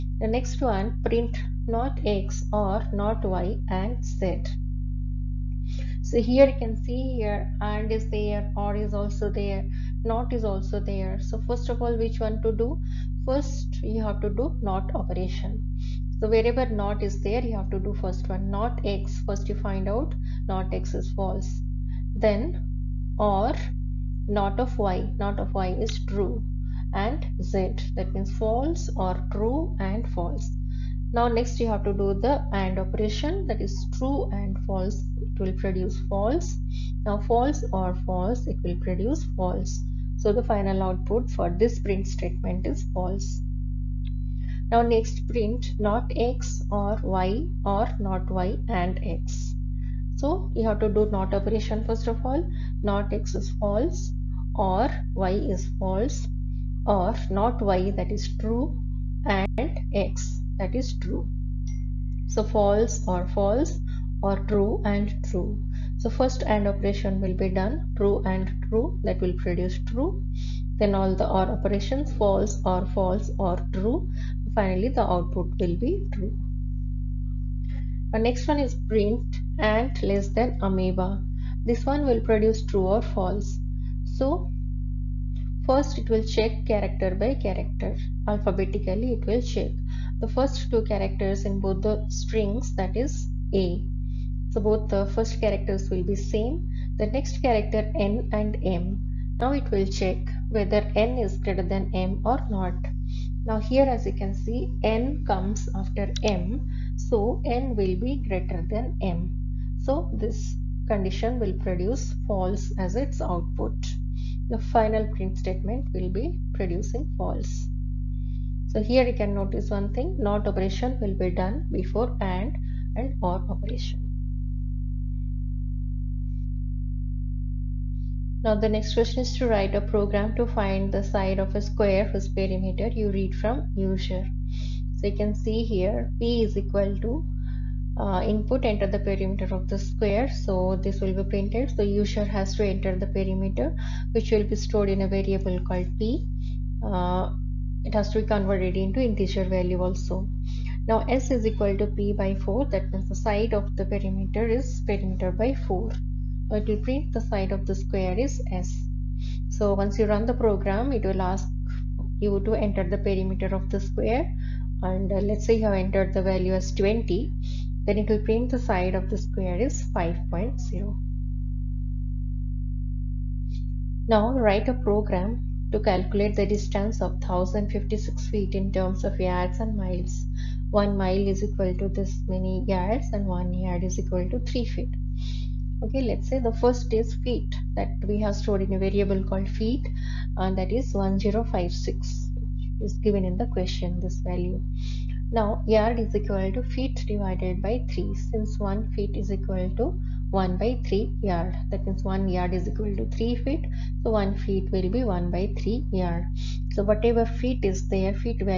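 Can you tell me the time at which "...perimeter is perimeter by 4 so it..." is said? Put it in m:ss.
2:33.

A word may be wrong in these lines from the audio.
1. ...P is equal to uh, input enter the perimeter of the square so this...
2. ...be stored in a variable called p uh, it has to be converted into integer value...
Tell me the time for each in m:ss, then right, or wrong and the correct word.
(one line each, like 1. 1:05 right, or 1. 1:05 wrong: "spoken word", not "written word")
1. 2:16 right
2. 2:24 right.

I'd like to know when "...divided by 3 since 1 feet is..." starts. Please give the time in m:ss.
3:17.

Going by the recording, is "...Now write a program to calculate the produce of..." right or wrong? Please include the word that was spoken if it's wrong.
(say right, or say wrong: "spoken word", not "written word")
wrong: "distance", not "produce".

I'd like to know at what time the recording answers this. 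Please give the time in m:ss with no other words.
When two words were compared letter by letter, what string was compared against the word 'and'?
1:20.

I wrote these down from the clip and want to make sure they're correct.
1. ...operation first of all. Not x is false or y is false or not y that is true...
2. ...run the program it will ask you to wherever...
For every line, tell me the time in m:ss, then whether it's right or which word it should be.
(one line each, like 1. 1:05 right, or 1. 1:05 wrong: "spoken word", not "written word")
1. 0:51 right
2. 2:40 wrong: "enter", not "wherever".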